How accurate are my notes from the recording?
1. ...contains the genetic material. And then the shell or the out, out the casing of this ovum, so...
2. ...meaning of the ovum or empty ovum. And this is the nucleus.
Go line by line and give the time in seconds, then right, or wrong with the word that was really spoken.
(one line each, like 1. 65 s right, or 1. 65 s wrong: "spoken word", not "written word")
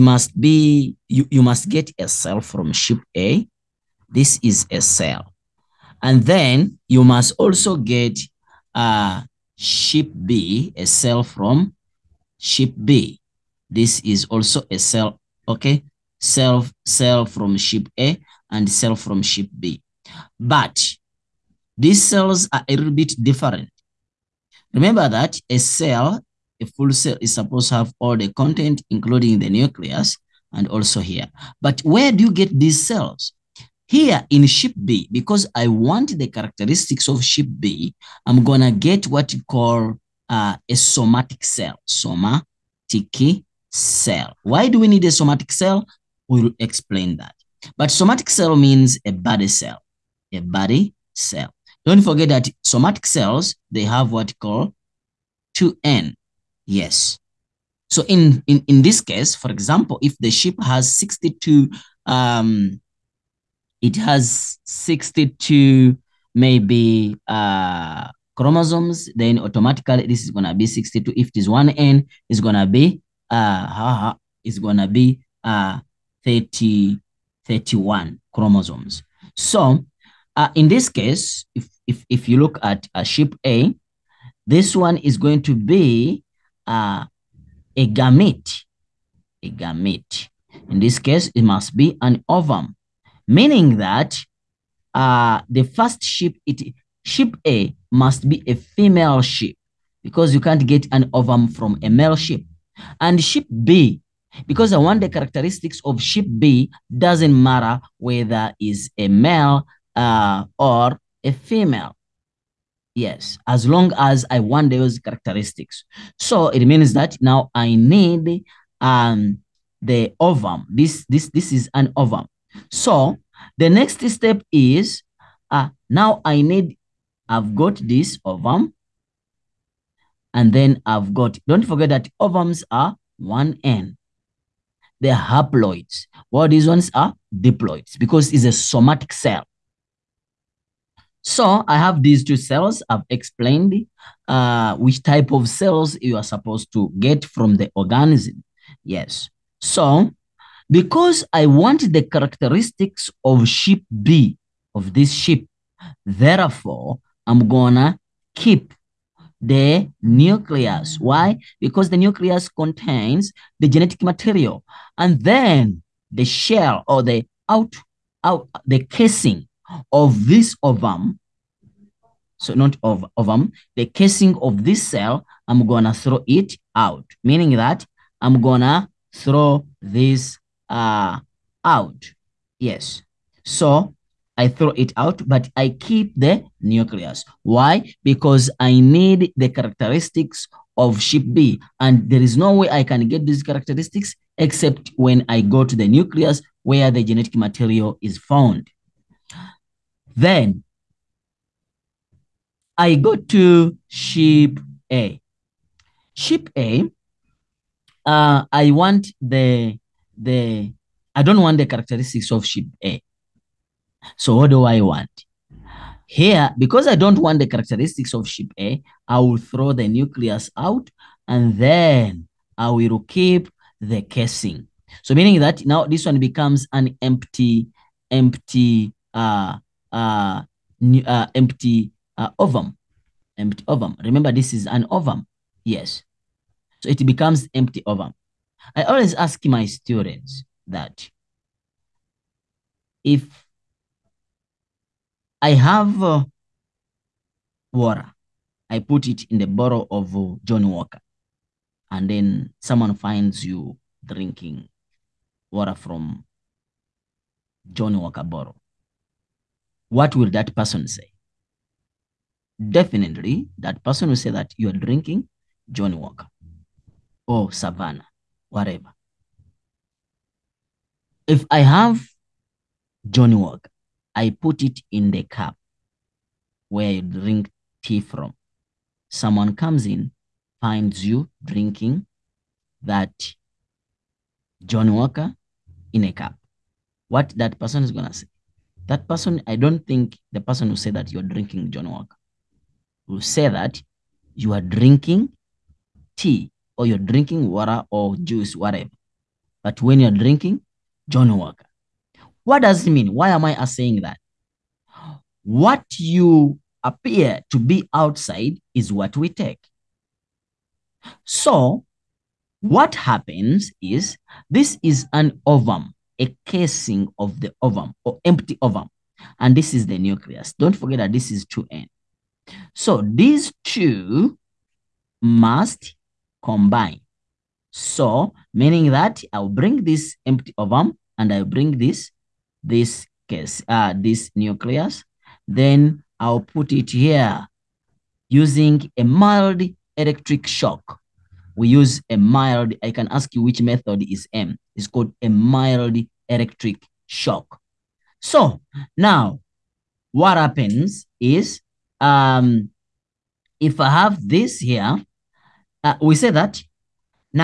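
1. 162 s right
2. 316 s wrong: "casing", not "meaning".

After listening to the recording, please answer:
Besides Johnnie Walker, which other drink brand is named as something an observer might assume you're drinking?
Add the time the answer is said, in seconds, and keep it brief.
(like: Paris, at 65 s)
Savannah, at 267 s.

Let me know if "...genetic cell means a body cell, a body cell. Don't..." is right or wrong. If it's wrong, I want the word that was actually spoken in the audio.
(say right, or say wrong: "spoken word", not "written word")
wrong: "somatic", not "genetic".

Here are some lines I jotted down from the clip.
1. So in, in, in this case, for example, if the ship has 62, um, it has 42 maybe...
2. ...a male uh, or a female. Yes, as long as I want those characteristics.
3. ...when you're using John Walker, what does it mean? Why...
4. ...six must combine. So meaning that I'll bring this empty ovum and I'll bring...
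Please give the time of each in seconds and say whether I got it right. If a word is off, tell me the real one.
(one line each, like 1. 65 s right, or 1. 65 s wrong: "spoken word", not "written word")
1. 57 s wrong: "62", not "42"
2. 108 s right
3. 299 s wrong: "drinking", not "using"
4. 323 s wrong: "two", not "six".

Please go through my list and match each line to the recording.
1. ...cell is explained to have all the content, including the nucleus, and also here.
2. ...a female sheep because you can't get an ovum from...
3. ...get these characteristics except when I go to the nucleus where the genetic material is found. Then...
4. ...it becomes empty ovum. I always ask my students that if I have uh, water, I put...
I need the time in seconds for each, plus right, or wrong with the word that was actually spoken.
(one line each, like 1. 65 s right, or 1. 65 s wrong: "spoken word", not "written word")
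1. 26 s wrong: "supposed", not "explained"
2. 98 s right
3. 193 s right
4. 236 s right.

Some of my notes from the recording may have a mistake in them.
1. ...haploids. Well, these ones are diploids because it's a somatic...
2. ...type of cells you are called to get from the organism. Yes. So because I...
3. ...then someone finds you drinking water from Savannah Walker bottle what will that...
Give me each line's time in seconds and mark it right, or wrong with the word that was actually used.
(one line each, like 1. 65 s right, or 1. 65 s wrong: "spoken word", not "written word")
1. 135 s right
2. 145 s wrong: "supposed", not "called"
3. 252 s wrong: "John", not "Savannah".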